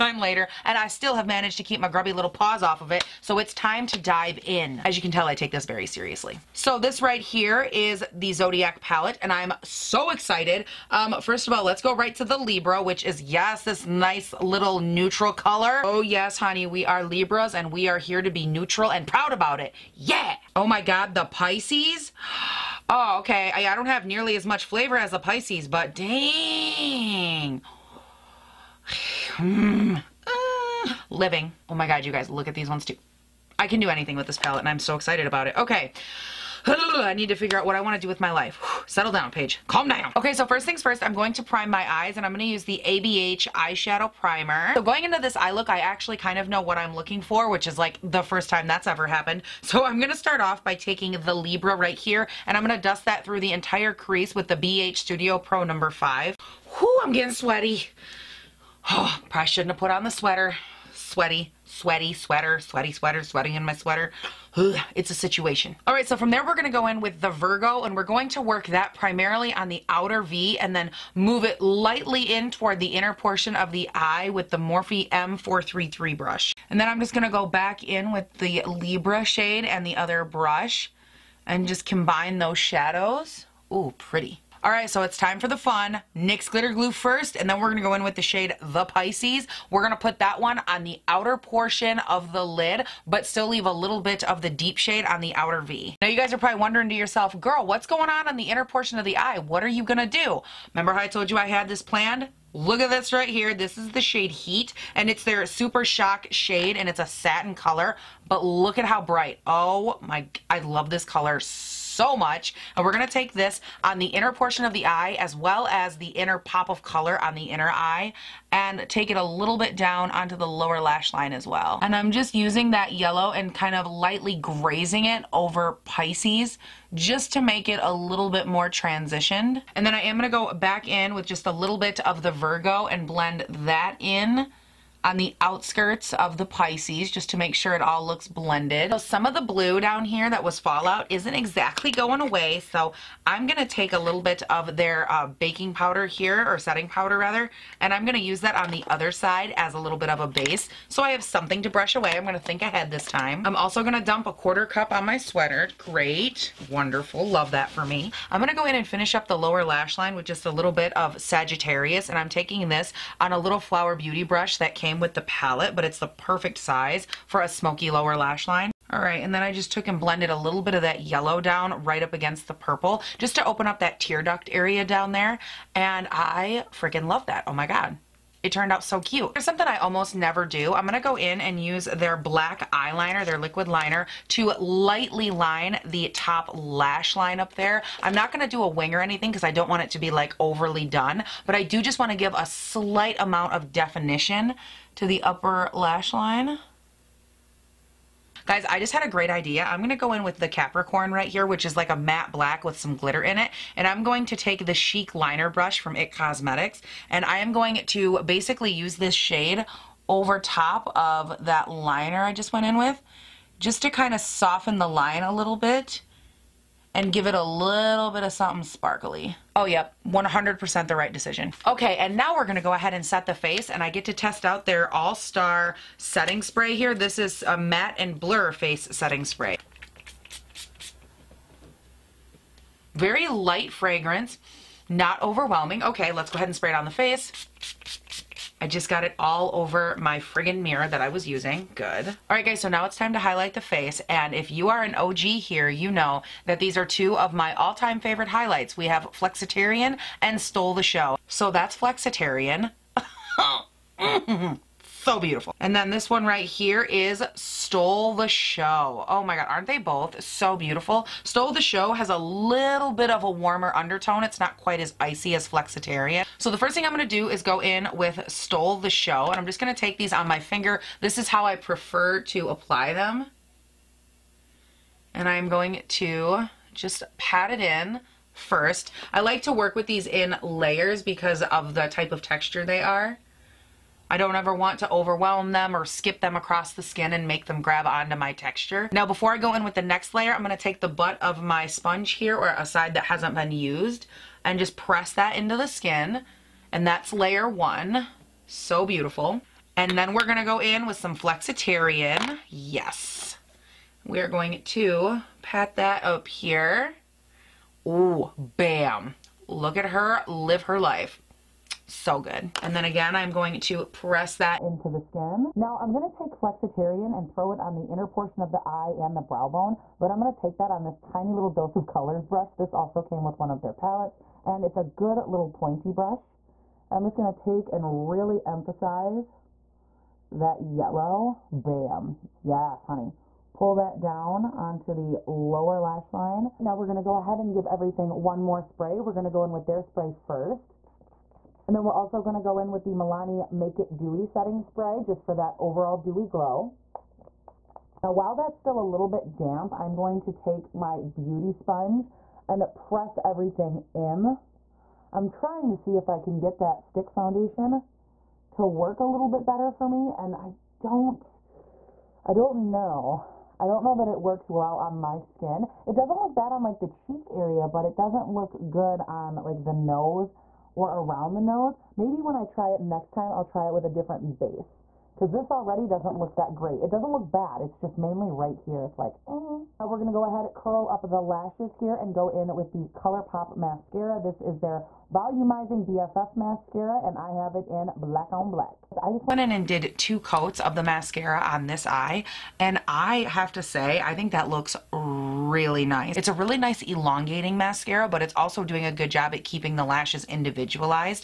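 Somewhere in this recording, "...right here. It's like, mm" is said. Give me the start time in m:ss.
6:18.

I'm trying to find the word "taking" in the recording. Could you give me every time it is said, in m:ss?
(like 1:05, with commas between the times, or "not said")
0:50, 2:42.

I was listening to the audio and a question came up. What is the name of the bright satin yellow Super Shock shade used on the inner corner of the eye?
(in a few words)
Heat.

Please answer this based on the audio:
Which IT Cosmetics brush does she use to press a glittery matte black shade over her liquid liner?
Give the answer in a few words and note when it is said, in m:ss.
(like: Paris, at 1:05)
Chic Liner Brush, at 3:24.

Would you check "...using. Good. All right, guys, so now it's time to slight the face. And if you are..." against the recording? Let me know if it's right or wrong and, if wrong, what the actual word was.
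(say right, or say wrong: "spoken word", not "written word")
wrong: "highlight", not "slight".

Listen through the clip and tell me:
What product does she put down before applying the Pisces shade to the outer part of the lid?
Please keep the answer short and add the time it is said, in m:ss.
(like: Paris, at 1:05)
NYX Glitter Glue, at 1:26.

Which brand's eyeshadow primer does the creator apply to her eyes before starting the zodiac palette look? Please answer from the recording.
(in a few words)
ABH.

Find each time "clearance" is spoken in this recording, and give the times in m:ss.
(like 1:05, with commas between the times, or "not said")
not said.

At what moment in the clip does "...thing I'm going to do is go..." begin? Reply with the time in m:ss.
4:26.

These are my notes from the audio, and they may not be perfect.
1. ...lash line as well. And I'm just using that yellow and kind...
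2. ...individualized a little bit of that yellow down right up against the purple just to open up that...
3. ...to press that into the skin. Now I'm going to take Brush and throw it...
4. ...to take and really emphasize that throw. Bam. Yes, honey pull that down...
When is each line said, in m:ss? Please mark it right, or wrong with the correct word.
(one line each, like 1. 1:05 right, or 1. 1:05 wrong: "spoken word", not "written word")
1. 2:00 right
2. 2:50 wrong: "blended", not "individualized"
3. 5:13 wrong: "Flexitarian", not "Brush"
4. 5:27 wrong: "yellow", not "throw".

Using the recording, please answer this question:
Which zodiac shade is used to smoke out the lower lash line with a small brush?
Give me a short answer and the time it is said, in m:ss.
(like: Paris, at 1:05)
Sagittarius, at 2:41.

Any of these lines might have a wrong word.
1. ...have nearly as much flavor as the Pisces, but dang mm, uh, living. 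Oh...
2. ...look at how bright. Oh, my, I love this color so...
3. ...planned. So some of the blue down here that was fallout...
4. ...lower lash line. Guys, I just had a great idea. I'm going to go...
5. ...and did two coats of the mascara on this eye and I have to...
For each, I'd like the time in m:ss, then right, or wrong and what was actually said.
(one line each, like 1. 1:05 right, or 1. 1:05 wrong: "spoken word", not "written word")
1. 0:23 right
2. 1:48 right
3. 2:18 wrong: "blended", not "planned"
4. 3:15 wrong: "upper", not "lower"
5. 6:29 right.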